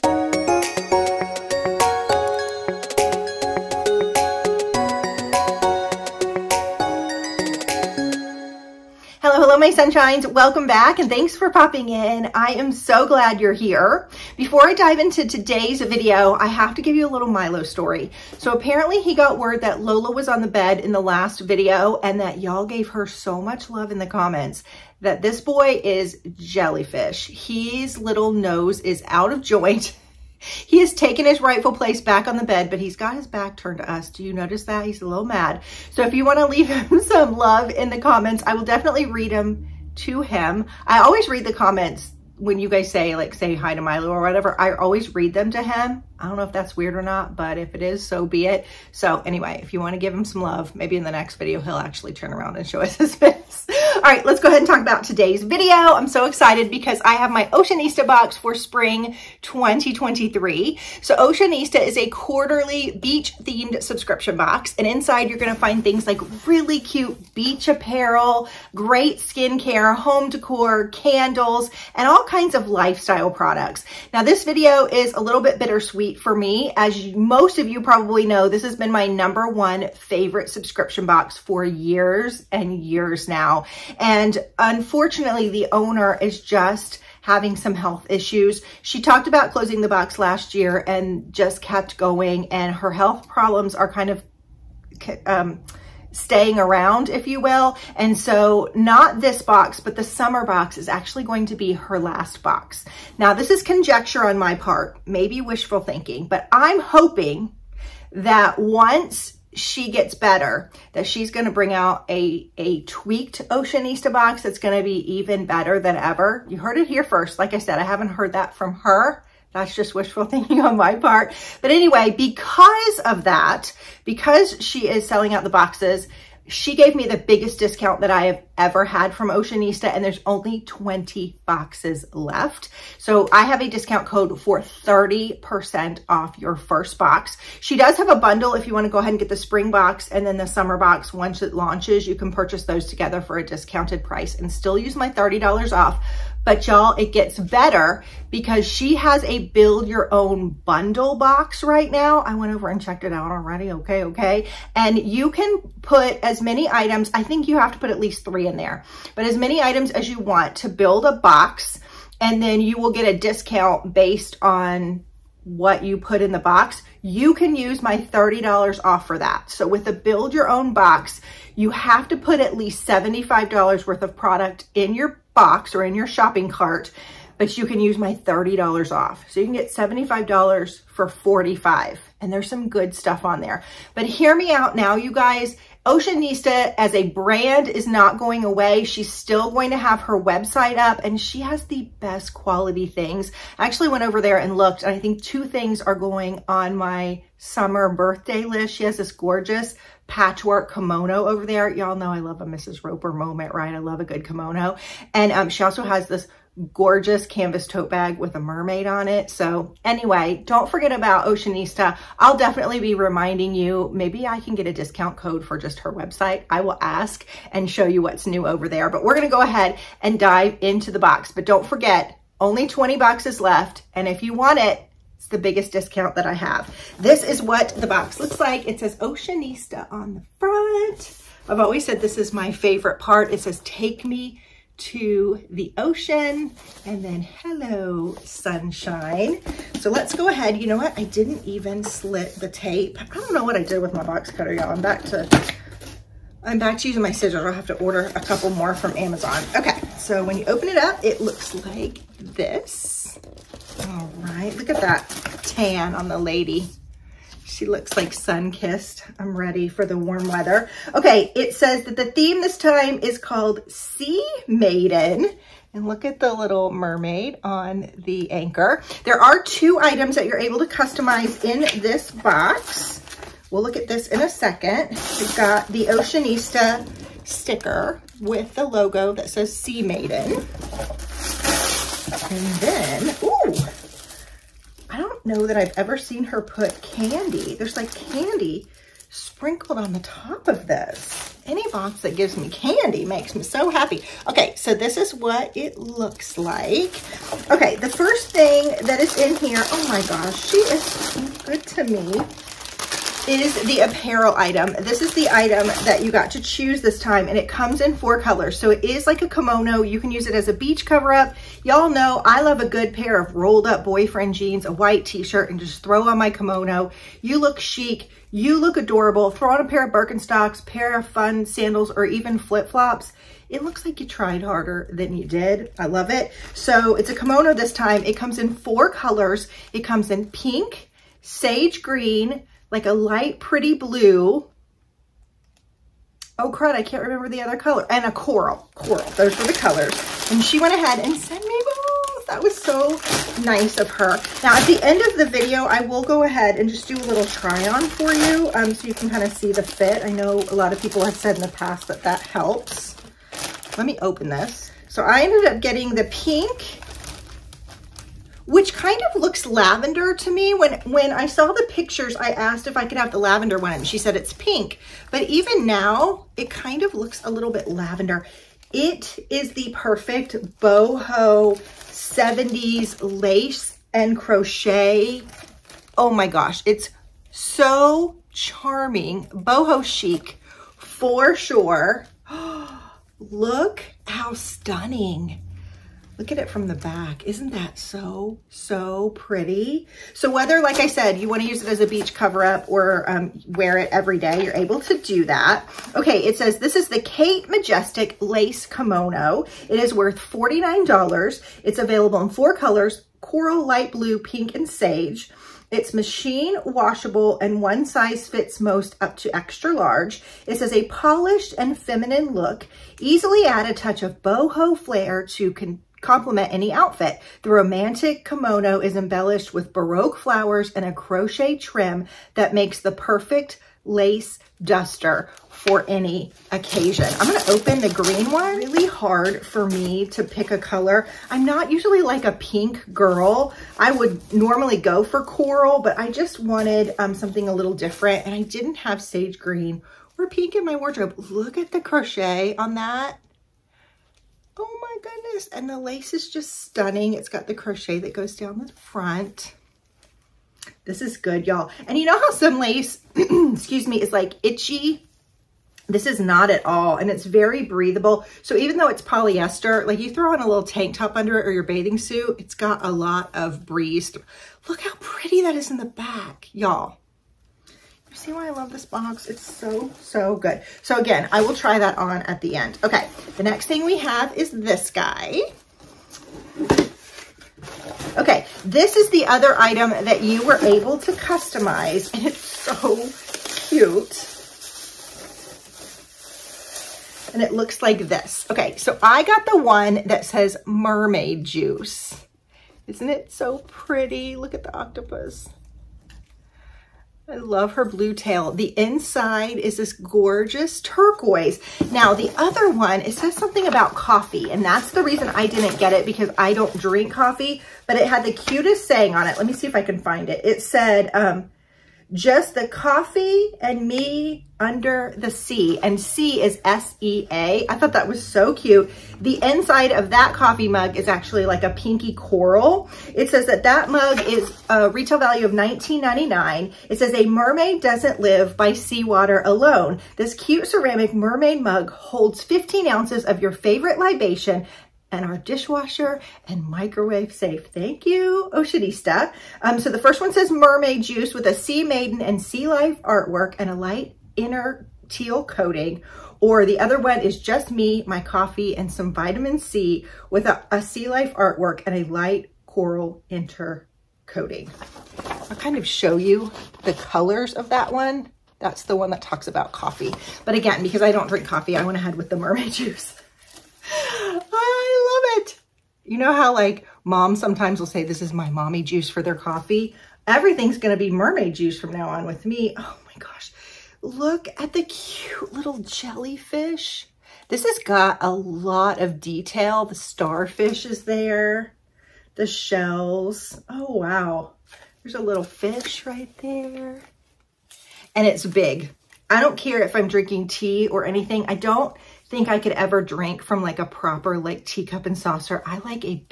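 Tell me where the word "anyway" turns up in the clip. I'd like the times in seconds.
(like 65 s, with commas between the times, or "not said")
49 s, 121 s, 209 s.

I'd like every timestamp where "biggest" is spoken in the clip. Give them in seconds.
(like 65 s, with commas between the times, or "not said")
127 s, 225 s.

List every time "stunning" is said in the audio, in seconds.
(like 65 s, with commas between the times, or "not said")
384 s, 446 s.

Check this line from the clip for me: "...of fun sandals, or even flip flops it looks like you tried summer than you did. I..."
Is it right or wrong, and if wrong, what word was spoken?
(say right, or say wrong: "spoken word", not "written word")
wrong: "harder", not "summer".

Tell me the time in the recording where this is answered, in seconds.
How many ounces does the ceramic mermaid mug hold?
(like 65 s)
532 s.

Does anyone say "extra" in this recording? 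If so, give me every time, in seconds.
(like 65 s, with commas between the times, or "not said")
409 s.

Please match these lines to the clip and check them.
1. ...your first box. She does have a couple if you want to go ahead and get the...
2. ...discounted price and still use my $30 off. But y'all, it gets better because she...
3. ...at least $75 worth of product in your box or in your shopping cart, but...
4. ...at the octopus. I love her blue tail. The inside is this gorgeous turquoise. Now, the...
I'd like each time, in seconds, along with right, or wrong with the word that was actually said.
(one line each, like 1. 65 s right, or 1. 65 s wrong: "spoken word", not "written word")
1. 136 s wrong: "bundle", not "couple"
2. 143 s right
3. 172 s right
4. 494 s right.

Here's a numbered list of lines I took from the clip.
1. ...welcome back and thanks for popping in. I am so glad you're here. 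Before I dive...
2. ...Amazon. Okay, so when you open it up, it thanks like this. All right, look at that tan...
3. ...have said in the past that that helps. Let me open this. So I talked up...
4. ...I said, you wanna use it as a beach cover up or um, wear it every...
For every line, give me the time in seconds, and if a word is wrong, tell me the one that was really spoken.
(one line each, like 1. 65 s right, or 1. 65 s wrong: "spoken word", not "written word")
1. 10 s right
2. 248 s wrong: "looks", not "thanks"
3. 351 s wrong: "ended", not "talked"
4. 390 s right.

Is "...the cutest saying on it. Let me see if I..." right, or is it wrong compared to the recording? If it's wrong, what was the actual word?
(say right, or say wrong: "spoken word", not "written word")
right.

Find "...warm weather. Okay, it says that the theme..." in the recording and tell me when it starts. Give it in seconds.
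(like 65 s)
259 s.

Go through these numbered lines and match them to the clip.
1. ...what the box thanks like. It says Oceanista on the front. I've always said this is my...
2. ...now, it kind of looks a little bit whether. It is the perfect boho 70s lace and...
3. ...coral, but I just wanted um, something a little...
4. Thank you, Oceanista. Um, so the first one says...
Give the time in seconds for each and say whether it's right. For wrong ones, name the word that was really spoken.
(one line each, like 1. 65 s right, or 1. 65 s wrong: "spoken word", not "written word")
1. 227 s wrong: "looks", not "thanks"
2. 365 s wrong: "lavender", not "whether"
3. 435 s right
4. 537 s right.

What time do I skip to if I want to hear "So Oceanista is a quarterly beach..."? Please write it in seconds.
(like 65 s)
61 s.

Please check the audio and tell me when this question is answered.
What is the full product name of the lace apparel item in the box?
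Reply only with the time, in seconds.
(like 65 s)
396 s.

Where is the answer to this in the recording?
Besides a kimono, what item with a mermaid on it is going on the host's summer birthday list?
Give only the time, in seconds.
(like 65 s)
207 s.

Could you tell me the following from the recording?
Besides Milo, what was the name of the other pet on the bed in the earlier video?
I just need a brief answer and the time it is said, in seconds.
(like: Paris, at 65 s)
Lola, at 19 s.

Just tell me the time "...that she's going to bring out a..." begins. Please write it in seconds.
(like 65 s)
110 s.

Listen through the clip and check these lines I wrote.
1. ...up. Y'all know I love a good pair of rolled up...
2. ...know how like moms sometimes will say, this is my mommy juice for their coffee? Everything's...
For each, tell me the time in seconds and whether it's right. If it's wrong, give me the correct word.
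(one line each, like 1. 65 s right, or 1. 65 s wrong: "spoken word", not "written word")
1. 311 s right
2. 566 s right.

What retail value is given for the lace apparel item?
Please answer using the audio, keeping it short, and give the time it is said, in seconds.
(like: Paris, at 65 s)
$49, at 400 s.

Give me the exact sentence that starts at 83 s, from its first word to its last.
And unfortunately, the owner is just having some health issues.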